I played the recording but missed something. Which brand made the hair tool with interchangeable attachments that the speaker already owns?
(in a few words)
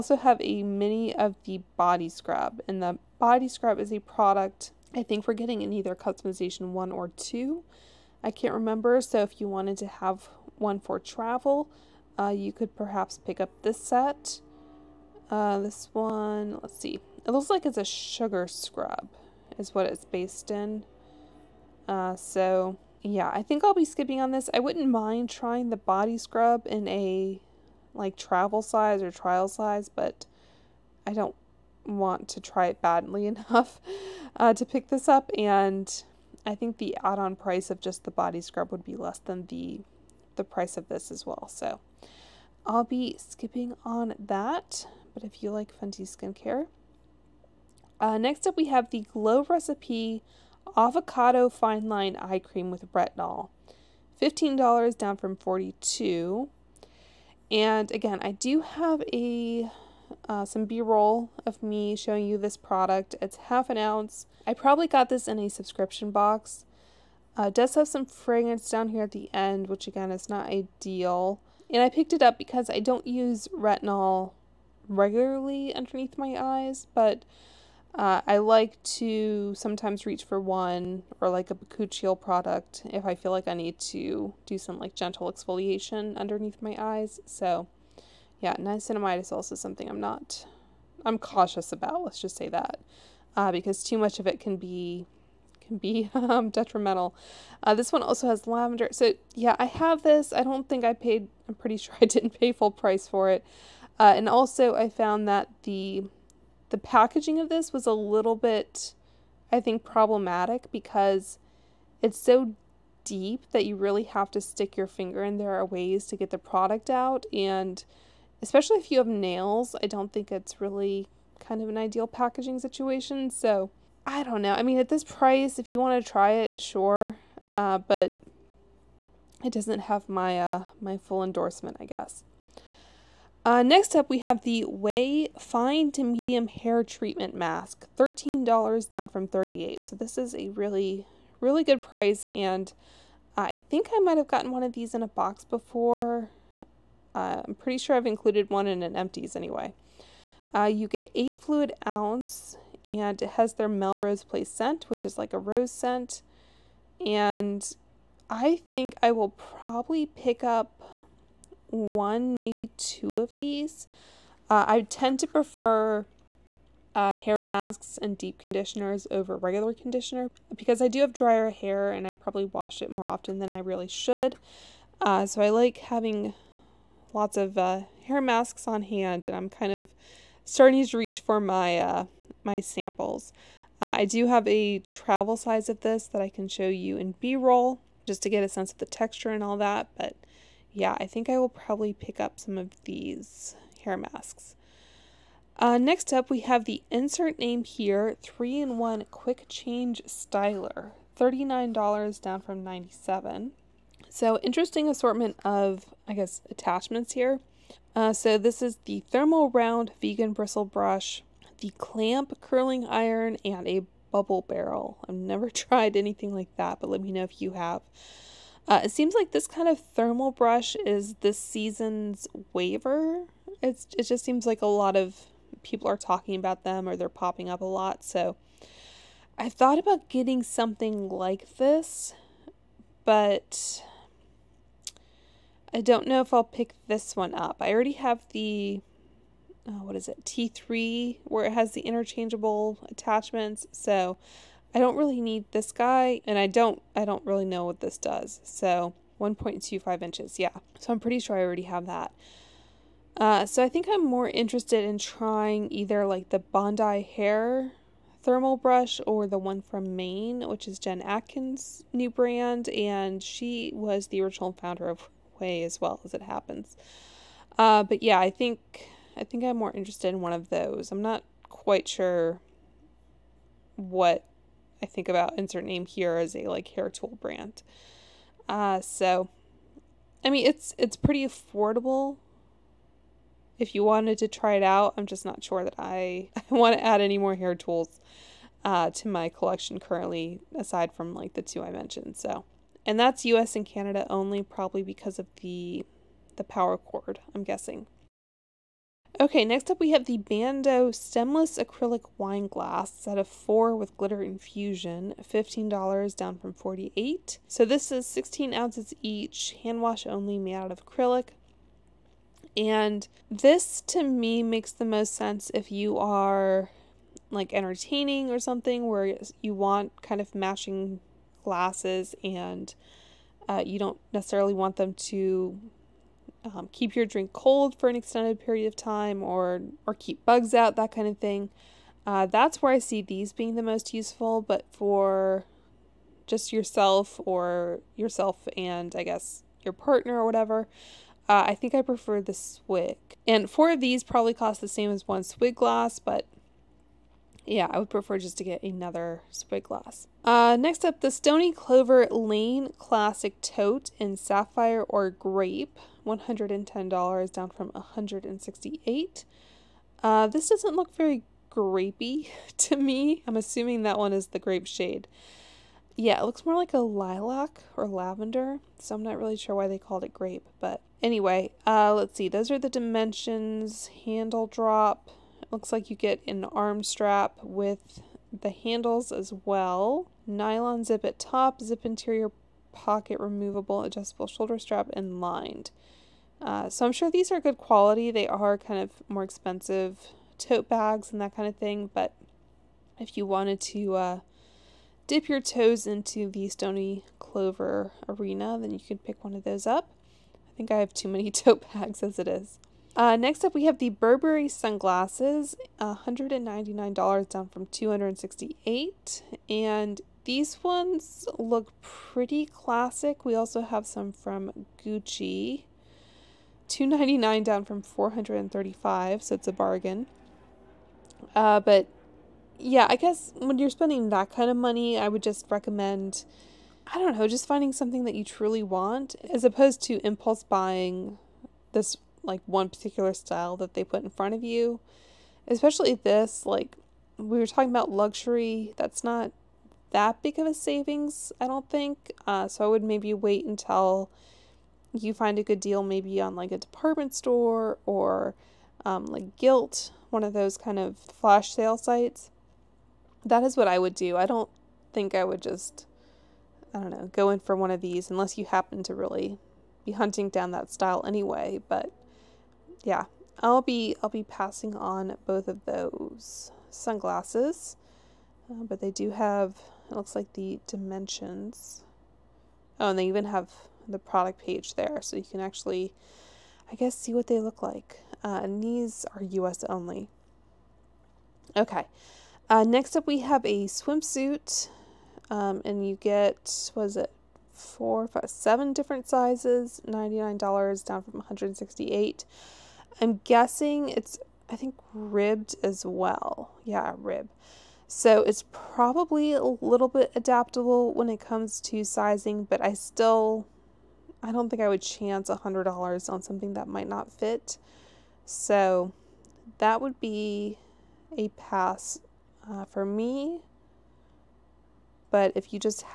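T3.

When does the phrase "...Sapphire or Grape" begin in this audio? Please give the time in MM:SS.
05:54.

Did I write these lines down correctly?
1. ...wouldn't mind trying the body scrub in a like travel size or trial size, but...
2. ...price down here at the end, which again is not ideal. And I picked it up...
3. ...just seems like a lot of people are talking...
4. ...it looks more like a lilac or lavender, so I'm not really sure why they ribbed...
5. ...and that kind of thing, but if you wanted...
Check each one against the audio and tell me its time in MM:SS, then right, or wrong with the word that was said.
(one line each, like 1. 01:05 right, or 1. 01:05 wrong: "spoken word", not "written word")
1. 00:24 right
2. 01:08 wrong: "fragrance", not "price"
3. 03:44 right
4. 06:06 wrong: "called", not "ribbed"
5. 06:31 right.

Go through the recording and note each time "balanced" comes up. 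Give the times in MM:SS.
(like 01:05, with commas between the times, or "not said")
not said.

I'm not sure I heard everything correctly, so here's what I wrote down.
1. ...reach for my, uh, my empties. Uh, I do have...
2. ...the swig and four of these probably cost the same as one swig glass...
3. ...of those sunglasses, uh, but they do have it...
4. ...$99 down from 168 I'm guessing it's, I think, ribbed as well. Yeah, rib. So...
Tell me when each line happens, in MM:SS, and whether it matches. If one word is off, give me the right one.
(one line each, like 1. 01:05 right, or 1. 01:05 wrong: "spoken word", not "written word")
1. 03:00 wrong: "samples", not "empties"
2. 05:42 right
3. 07:45 right
4. 08:09 right.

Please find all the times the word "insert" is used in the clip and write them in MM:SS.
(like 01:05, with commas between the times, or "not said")
03:16, 04:35.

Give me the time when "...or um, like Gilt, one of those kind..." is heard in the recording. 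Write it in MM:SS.
07:27.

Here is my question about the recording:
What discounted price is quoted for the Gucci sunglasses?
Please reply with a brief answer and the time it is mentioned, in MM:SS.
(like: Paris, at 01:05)
$299, at 06:56.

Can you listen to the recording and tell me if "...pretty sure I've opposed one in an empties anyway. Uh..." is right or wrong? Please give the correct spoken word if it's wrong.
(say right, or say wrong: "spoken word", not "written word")
wrong: "included", not "opposed".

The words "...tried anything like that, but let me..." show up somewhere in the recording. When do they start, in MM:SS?
03:35.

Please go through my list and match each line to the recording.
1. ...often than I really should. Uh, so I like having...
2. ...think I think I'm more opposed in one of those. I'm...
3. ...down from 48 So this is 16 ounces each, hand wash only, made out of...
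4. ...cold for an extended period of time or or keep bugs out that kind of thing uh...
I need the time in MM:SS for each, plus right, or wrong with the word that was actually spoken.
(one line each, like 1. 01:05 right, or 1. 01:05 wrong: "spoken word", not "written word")
1. 02:53 right
2. 04:28 wrong: "interested", not "opposed"
3. 05:06 right
4. 05:27 right.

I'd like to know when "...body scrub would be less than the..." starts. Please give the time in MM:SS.
00:38.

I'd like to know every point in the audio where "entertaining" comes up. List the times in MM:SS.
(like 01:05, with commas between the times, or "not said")
05:17.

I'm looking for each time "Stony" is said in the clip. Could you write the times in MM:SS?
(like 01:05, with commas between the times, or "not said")
05:51, 06:36.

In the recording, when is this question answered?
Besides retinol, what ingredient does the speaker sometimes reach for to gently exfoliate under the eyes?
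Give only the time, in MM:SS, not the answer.
01:21.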